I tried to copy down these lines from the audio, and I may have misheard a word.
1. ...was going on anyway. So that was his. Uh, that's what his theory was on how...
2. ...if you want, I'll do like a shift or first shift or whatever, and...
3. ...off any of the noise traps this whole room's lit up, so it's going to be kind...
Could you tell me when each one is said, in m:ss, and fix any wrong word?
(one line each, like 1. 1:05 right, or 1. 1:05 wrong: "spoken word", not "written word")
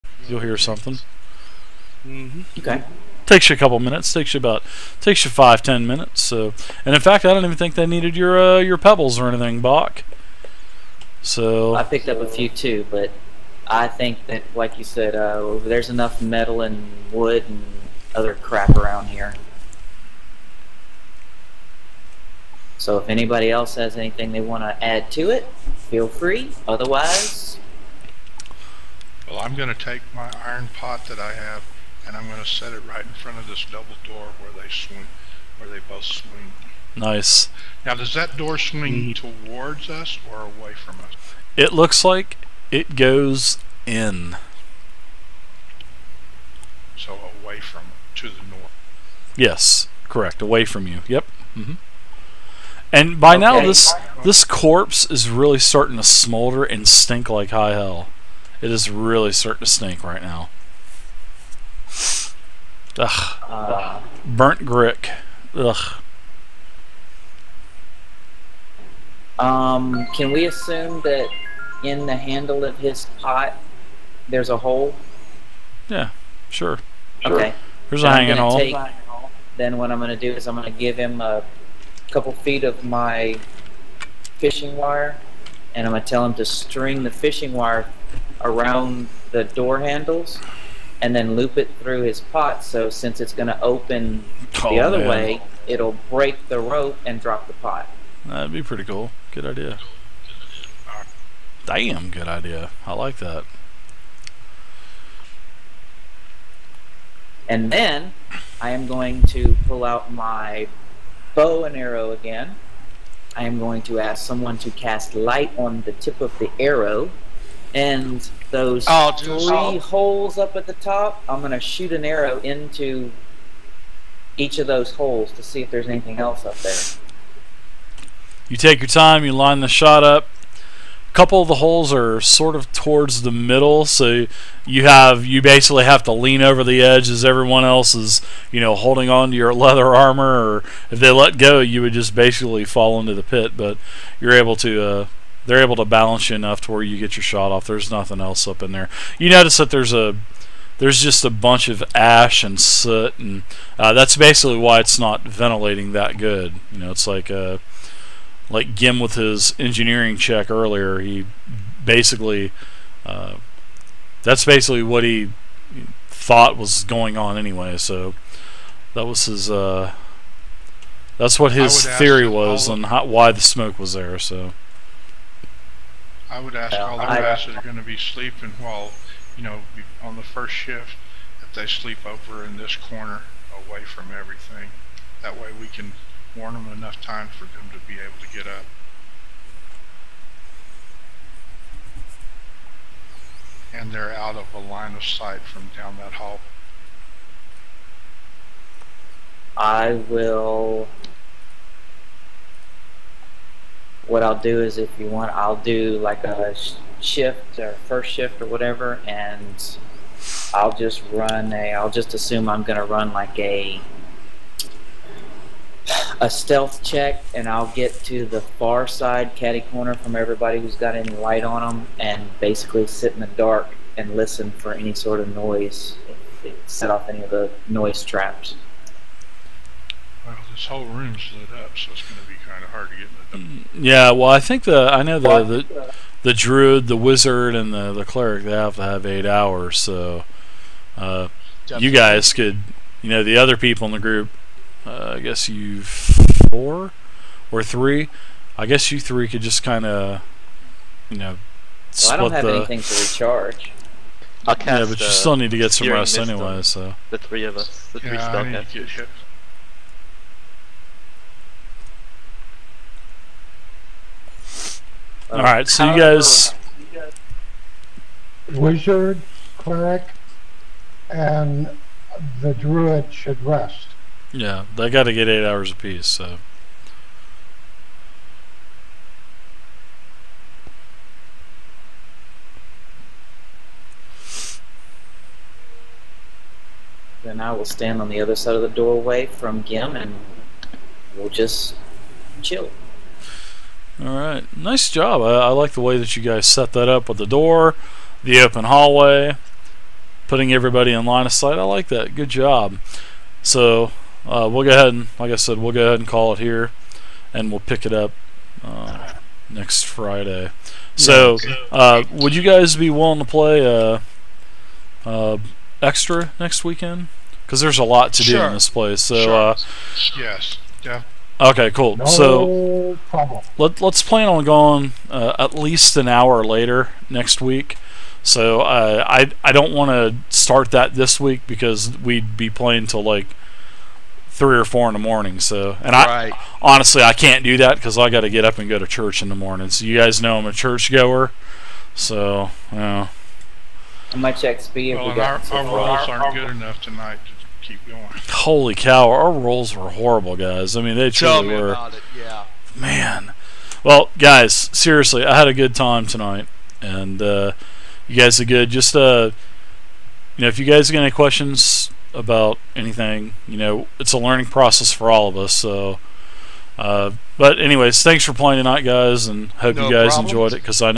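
1. 2:46 right
2. 3:24 right
3. 3:46 right.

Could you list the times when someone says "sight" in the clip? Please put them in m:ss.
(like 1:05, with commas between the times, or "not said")
3:15, 5:01.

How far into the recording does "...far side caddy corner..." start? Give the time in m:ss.
3:38.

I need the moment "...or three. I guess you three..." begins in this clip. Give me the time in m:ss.
4:07.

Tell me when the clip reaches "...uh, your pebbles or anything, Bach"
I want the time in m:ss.
0:08.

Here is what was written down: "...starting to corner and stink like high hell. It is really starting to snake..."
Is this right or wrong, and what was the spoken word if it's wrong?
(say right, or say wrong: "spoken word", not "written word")
wrong: "smolder", not "corner".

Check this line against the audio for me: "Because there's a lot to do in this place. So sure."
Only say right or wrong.
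right.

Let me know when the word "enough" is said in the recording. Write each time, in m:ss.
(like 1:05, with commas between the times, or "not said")
0:15, 2:26, 3:06, 5:46.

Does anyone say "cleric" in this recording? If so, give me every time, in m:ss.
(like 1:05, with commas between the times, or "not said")
3:58, 4:29.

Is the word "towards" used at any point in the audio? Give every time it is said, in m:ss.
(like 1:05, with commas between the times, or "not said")
0:39, 2:12.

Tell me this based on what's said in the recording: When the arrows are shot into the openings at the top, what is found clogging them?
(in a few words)
ash and soot.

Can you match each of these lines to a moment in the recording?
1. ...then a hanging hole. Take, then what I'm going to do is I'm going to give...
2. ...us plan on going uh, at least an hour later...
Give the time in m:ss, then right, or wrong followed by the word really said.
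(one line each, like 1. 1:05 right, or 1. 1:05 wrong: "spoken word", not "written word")
1. 1:18 right
2. 5:23 right.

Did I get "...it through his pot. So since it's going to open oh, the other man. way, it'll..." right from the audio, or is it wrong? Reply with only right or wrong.
right.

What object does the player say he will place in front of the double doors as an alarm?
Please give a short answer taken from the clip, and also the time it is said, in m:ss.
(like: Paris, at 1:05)
iron pot, at 0:30.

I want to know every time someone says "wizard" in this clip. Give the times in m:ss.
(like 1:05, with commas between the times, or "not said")
3:56, 4:28.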